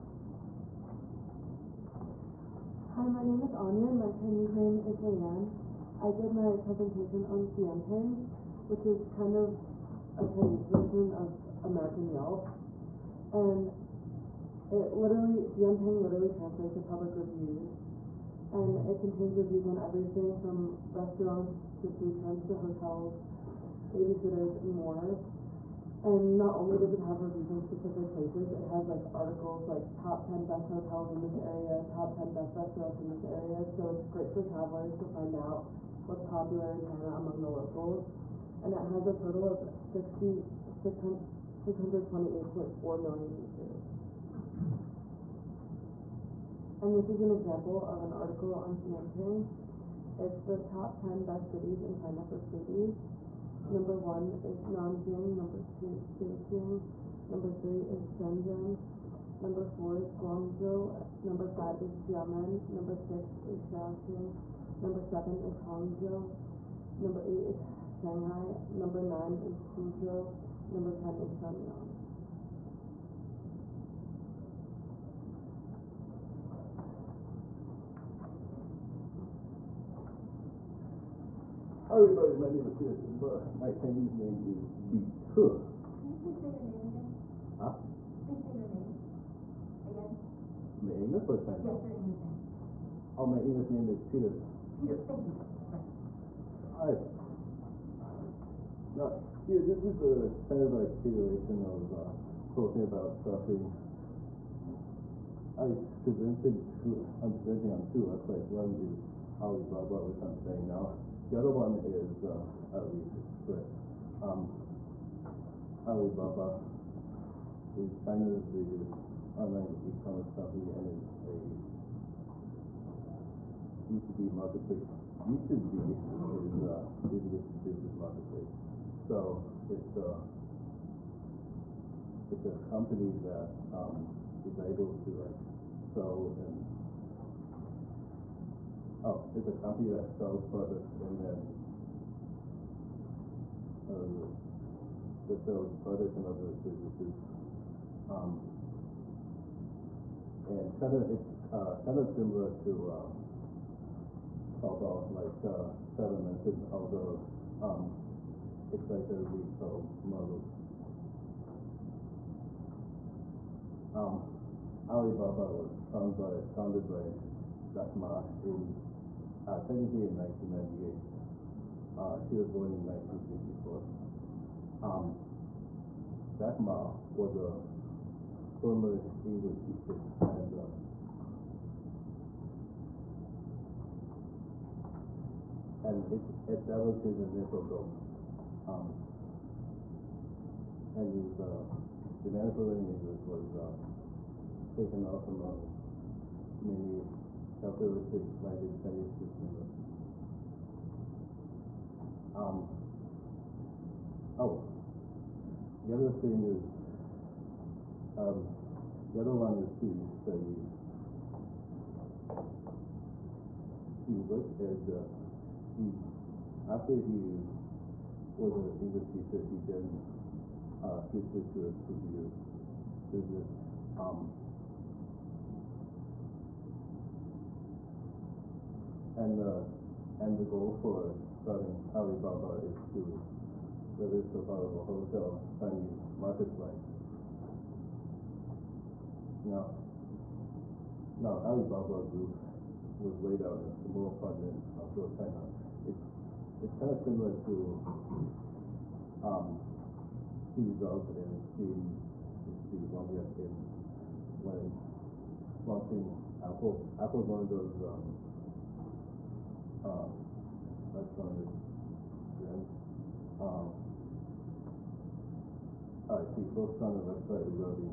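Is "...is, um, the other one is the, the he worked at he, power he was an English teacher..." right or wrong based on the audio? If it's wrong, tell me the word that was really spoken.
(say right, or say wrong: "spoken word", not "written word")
wrong: "after", not "power".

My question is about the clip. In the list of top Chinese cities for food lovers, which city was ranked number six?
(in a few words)
Shaoxing.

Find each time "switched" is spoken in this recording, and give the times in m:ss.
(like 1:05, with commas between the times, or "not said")
3:40.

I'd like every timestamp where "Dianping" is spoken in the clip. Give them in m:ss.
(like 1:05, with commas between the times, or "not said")
0:07, 0:15, 0:48.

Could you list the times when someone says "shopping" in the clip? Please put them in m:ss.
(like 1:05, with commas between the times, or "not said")
1:43.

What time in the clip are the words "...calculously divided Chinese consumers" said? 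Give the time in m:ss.
3:17.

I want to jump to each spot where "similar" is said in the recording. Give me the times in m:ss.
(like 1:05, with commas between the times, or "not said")
2:32, 4:06.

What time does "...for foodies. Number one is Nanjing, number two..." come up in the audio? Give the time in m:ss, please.
0:52.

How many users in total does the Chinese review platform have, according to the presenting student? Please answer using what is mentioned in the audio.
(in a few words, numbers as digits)
628.4 million.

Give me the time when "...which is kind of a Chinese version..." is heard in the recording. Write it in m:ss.
0:08.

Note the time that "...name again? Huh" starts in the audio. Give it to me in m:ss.
1:26.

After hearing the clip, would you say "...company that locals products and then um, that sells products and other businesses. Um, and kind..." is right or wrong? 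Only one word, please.
wrong.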